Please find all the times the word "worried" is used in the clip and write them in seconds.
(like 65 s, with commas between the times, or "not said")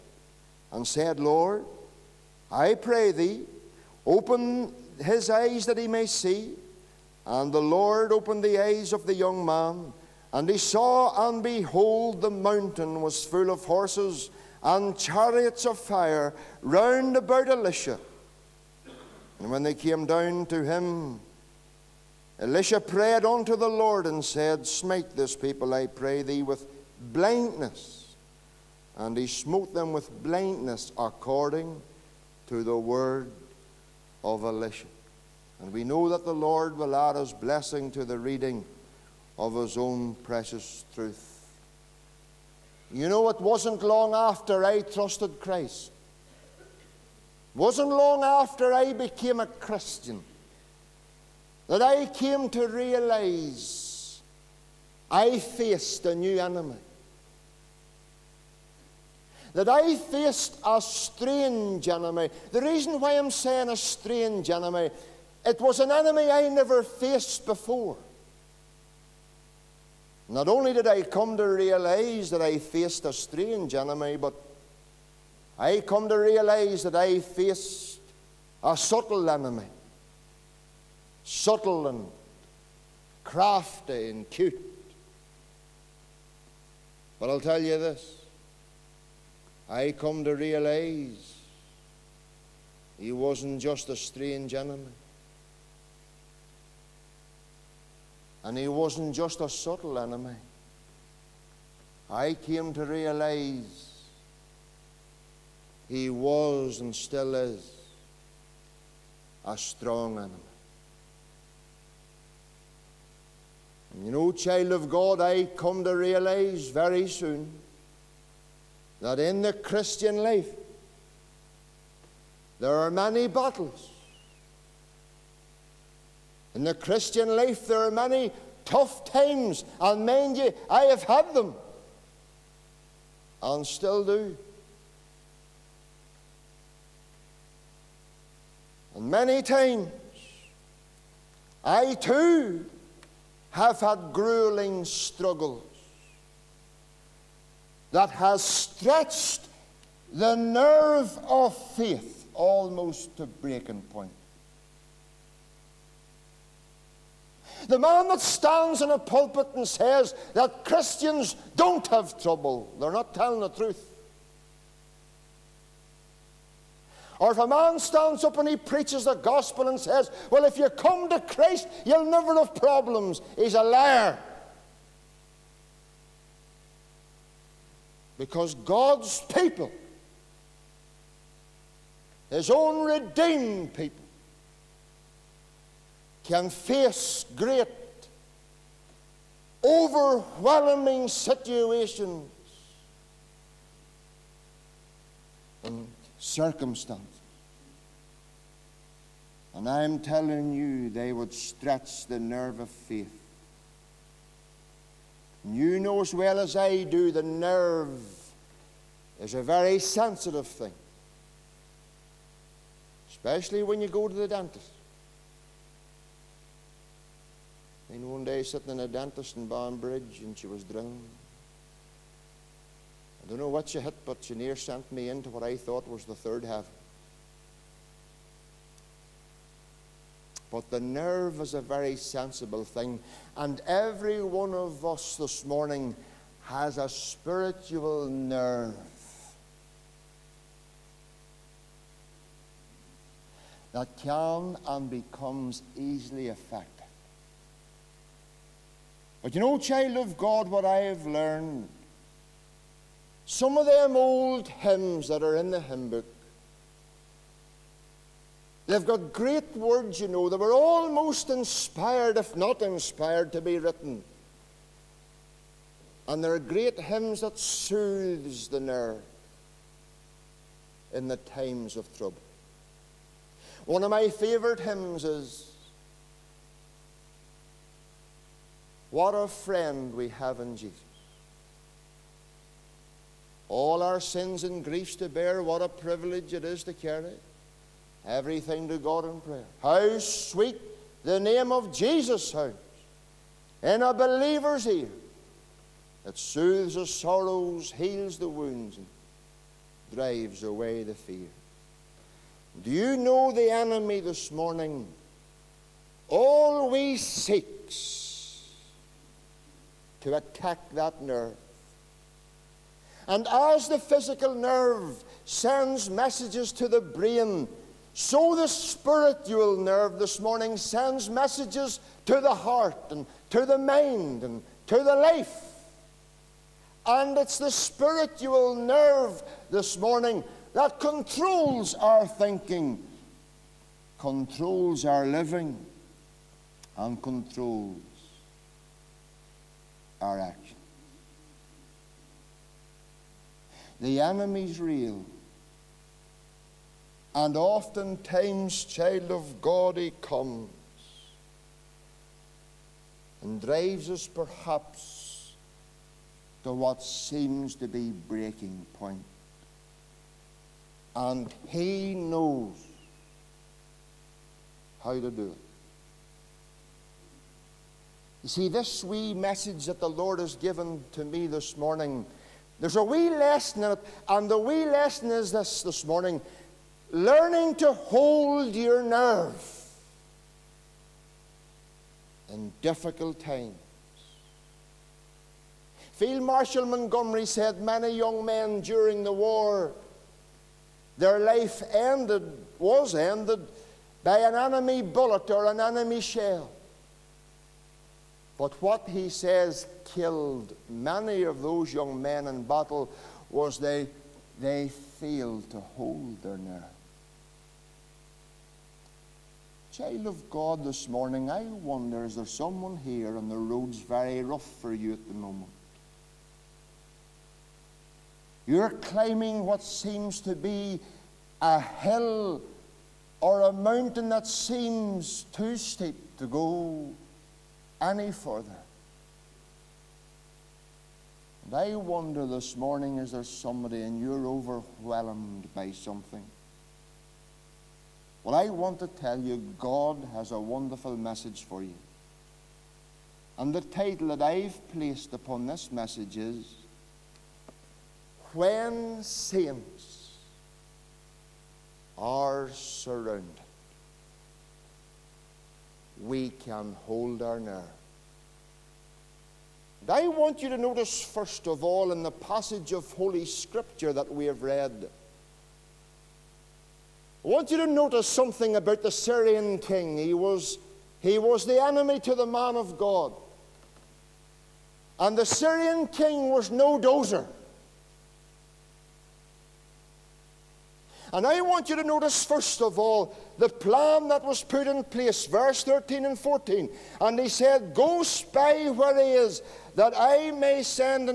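not said.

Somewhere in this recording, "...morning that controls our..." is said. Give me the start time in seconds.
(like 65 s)
329 s.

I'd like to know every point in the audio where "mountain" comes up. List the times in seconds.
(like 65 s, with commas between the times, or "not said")
12 s, 423 s.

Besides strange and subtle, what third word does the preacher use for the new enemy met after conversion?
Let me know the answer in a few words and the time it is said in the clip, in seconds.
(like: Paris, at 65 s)
Strong, at 109 s.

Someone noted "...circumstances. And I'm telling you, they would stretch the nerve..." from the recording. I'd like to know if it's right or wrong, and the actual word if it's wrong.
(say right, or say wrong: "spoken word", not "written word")
right.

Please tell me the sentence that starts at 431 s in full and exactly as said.
And I wonder this morning is there somebody and you're overwhelmed by something?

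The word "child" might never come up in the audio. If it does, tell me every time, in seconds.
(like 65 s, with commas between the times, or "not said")
114 s, 249 s, 348 s, 409 s.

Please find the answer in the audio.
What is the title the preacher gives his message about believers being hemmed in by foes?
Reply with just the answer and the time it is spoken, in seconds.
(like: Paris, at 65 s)
When Saints Are Surrounded, at 448 s.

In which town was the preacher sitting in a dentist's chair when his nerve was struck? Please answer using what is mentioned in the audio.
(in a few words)
Banbridge.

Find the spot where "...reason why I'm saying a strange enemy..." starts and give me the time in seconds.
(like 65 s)
62 s.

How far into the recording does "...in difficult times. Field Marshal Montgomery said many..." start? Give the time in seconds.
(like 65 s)
382 s.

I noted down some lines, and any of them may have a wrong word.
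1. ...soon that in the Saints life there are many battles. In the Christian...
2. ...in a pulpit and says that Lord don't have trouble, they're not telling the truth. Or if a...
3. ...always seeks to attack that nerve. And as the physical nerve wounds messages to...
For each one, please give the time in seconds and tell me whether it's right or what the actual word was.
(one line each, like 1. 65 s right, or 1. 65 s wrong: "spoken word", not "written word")
1. 117 s wrong: "Christian", not "Saints"
2. 158 s wrong: "Christians", not "Lord"
3. 306 s wrong: "sends", not "wounds".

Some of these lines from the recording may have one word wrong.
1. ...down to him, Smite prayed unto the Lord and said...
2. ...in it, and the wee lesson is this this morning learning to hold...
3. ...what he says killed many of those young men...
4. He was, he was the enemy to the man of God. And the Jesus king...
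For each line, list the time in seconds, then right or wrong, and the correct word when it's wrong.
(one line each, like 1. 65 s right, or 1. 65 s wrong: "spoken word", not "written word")
1. 20 s wrong: "Elisha", not "Smite"
2. 373 s right
3. 398 s right
4. 469 s wrong: "Syrian", not "Jesus".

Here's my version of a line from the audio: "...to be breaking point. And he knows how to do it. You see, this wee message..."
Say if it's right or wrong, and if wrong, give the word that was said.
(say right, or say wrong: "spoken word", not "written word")
right.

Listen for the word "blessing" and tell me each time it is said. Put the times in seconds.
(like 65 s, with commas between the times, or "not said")
37 s.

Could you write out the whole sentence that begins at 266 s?
And there are great hymns that soothes the nerve in the times of trouble.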